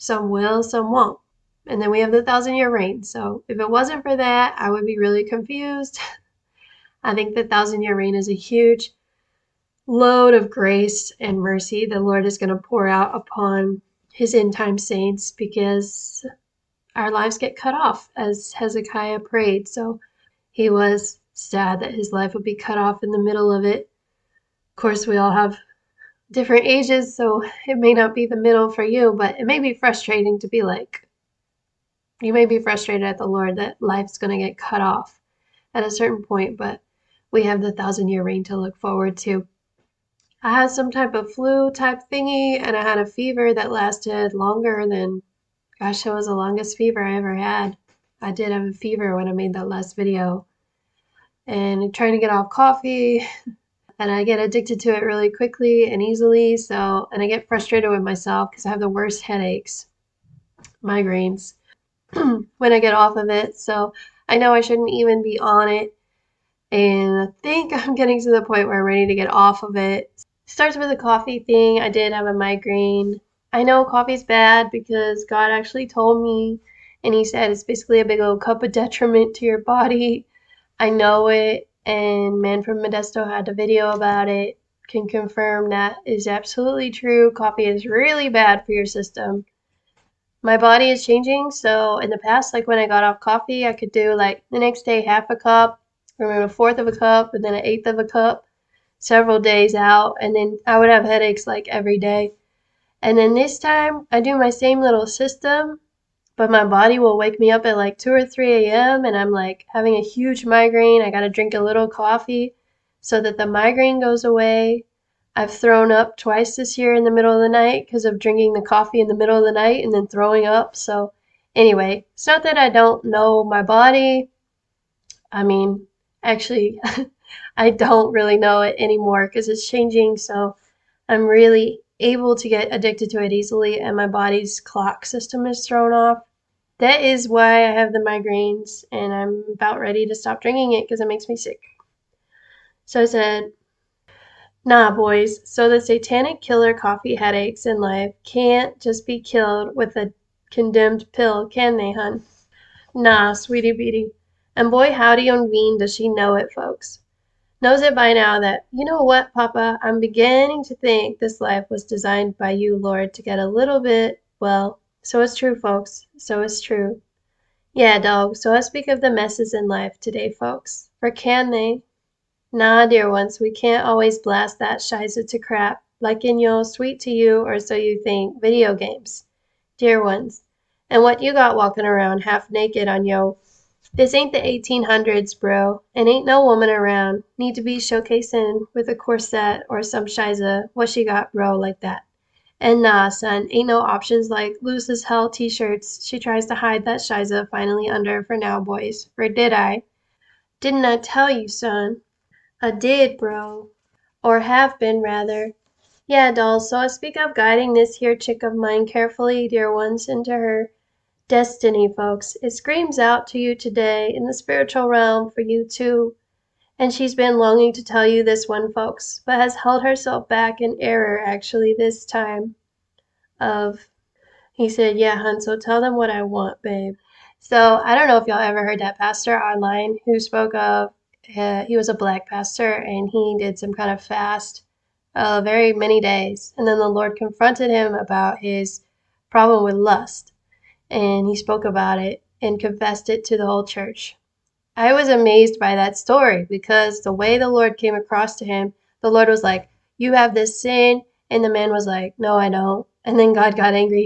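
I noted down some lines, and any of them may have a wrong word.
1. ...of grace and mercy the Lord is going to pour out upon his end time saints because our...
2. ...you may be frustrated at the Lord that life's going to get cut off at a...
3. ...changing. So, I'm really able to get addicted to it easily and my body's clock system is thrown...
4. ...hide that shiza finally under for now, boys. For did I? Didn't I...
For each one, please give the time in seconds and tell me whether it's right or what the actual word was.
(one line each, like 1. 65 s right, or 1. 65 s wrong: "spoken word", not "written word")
1. 10 s right
2. 32 s right
3. 129 s right
4. 196 s right.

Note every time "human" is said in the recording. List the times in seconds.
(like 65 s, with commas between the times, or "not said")
not said.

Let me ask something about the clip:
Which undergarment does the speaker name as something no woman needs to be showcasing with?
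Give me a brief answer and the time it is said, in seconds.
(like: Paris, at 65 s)
corset, at 188 s.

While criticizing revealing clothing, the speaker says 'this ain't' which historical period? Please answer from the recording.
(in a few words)
the 1800s.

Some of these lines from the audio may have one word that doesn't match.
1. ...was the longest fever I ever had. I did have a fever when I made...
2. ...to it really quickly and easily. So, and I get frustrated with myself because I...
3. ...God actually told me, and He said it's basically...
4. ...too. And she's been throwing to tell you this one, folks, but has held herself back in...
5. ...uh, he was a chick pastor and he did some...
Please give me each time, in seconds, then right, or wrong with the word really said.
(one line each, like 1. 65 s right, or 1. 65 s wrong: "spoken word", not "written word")
1. 46 s right
2. 54 s right
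3. 75 s right
4. 215 s wrong: "longing", not "throwing"
5. 231 s wrong: "black", not "chick".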